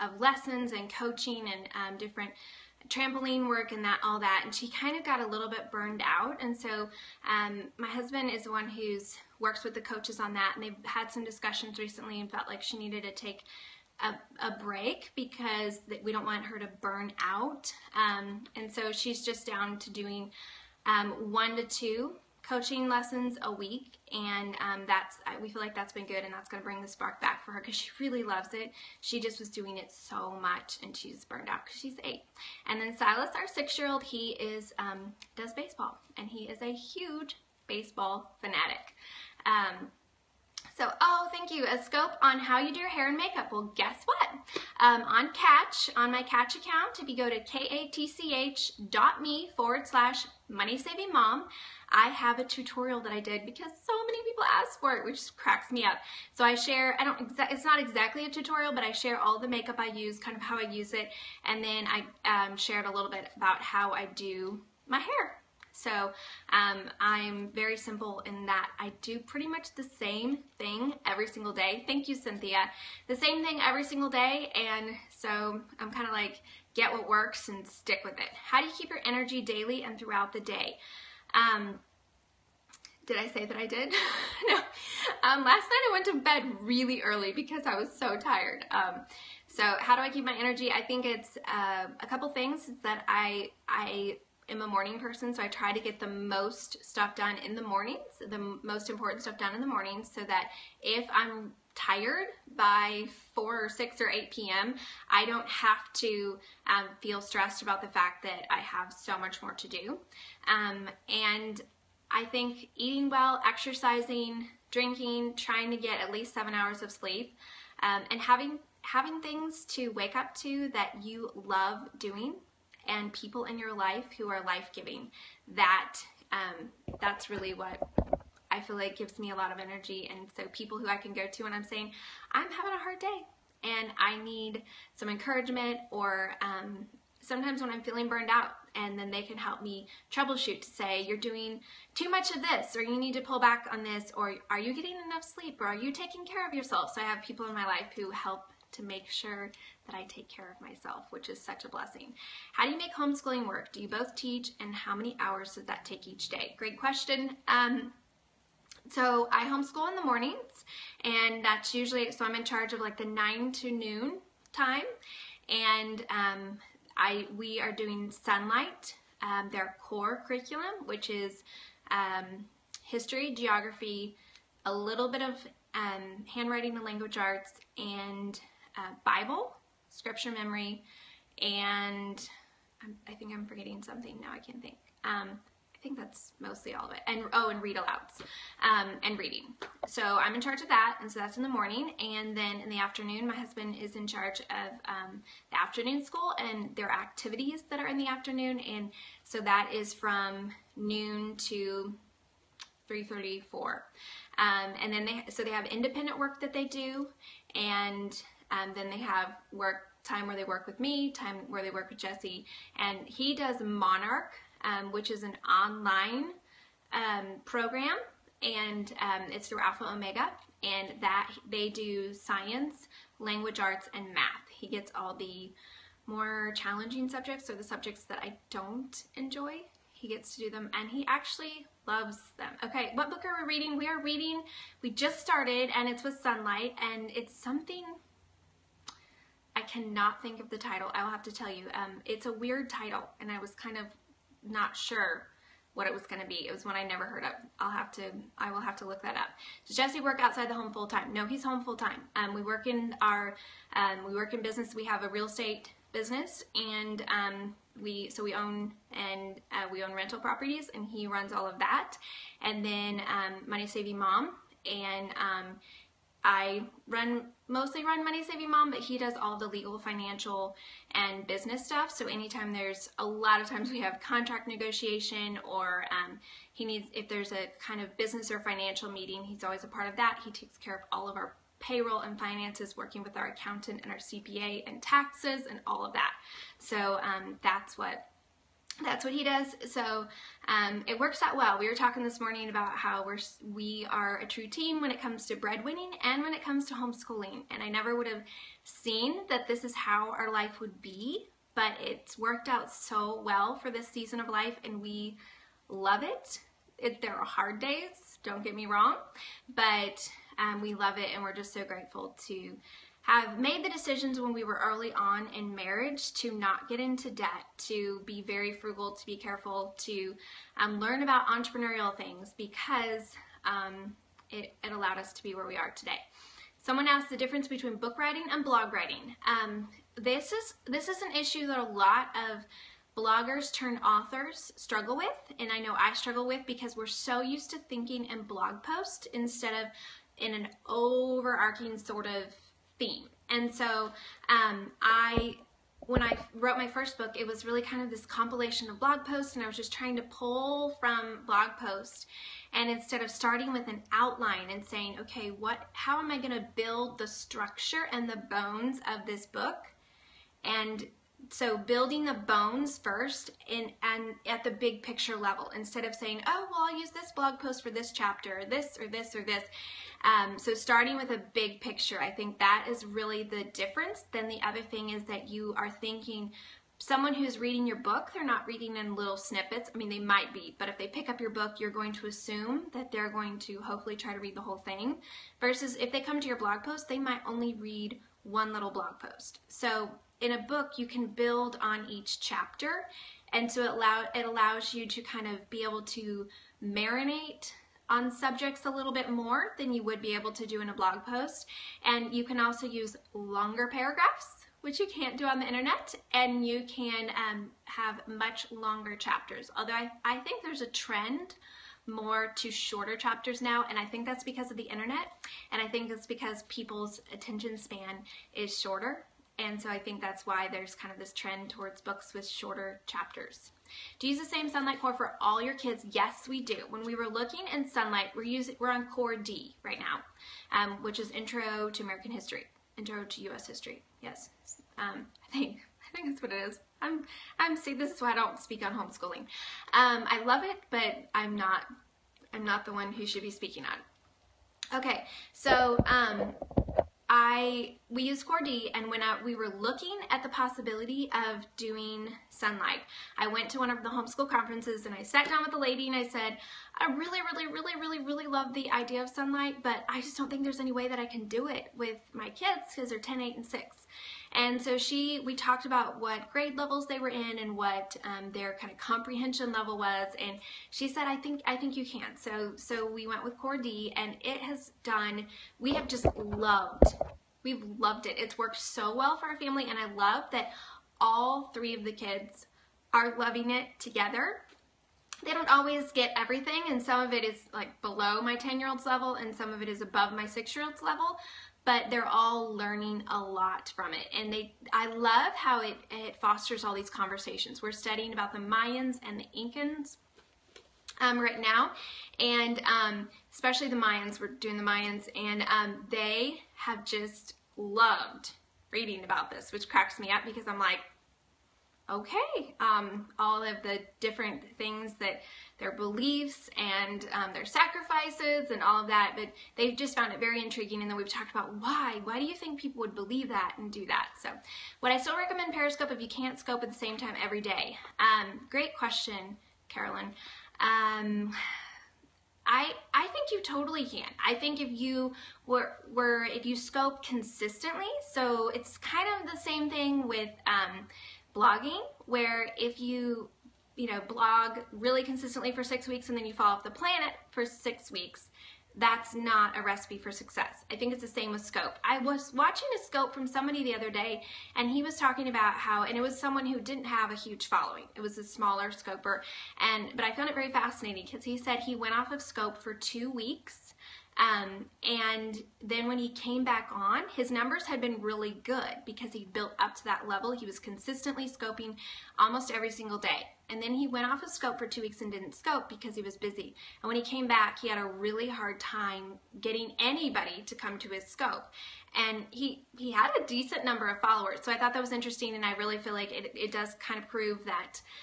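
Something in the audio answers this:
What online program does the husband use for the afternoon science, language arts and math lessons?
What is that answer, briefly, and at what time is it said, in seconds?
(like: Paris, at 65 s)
Monarch, at 213 s.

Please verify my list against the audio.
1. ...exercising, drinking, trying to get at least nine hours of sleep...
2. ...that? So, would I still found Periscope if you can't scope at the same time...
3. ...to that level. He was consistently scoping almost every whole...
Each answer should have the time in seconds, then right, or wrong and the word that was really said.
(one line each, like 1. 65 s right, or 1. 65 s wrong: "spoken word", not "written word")
1. 113 s wrong: "seven", not "nine"
2. 523 s wrong: "recommend", not "found"
3. 569 s wrong: "single", not "whole".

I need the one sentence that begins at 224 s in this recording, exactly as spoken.
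He gets all the more challenging subjects or the subjects that I don't enjoy.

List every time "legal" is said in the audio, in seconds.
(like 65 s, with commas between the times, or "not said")
269 s.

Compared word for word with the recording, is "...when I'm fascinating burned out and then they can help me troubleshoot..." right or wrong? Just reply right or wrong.
wrong.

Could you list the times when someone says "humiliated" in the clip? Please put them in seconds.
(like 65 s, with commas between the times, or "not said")
not said.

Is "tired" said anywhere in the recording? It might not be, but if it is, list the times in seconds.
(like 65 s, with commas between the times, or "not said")
88 s, 101 s.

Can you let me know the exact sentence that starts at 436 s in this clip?
I'm I'm see this is why I don't speak on homeschooling.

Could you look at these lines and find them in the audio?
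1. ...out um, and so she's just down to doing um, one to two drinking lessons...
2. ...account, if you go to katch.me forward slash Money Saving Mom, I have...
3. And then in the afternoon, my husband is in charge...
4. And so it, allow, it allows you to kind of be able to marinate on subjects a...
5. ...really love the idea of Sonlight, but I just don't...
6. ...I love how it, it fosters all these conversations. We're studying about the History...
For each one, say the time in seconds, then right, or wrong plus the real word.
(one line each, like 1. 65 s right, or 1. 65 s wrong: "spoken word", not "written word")
1. 17 s wrong: "coaching", not "drinking"
2. 46 s right
3. 191 s right
4. 393 s right
5. 458 s right
6. 494 s wrong: "Mayans", not "History".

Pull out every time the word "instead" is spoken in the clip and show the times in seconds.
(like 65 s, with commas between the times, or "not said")
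339 s, 352 s, 365 s.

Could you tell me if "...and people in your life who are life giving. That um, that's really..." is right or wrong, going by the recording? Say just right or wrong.
right.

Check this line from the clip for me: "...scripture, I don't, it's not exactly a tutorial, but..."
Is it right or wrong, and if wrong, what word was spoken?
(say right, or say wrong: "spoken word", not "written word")
wrong: "share", not "scripture".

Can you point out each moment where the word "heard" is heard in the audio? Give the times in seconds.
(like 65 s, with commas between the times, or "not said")
247 s.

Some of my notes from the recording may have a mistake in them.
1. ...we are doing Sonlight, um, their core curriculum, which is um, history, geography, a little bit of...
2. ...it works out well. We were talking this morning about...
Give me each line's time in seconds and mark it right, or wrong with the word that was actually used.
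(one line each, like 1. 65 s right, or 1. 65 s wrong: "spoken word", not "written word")
1. 167 s right
2. 290 s right.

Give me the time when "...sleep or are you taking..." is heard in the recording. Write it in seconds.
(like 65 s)
145 s.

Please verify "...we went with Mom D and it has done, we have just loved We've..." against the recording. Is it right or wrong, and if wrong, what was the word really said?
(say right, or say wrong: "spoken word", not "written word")
wrong: "Core", not "Mom".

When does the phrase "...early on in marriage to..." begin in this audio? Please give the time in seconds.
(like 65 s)
314 s.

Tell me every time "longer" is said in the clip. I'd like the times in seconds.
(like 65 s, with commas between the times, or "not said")
403 s, 408 s.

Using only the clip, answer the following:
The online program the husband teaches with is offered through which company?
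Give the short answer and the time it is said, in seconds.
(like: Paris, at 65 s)
Alpha Omega, at 219 s.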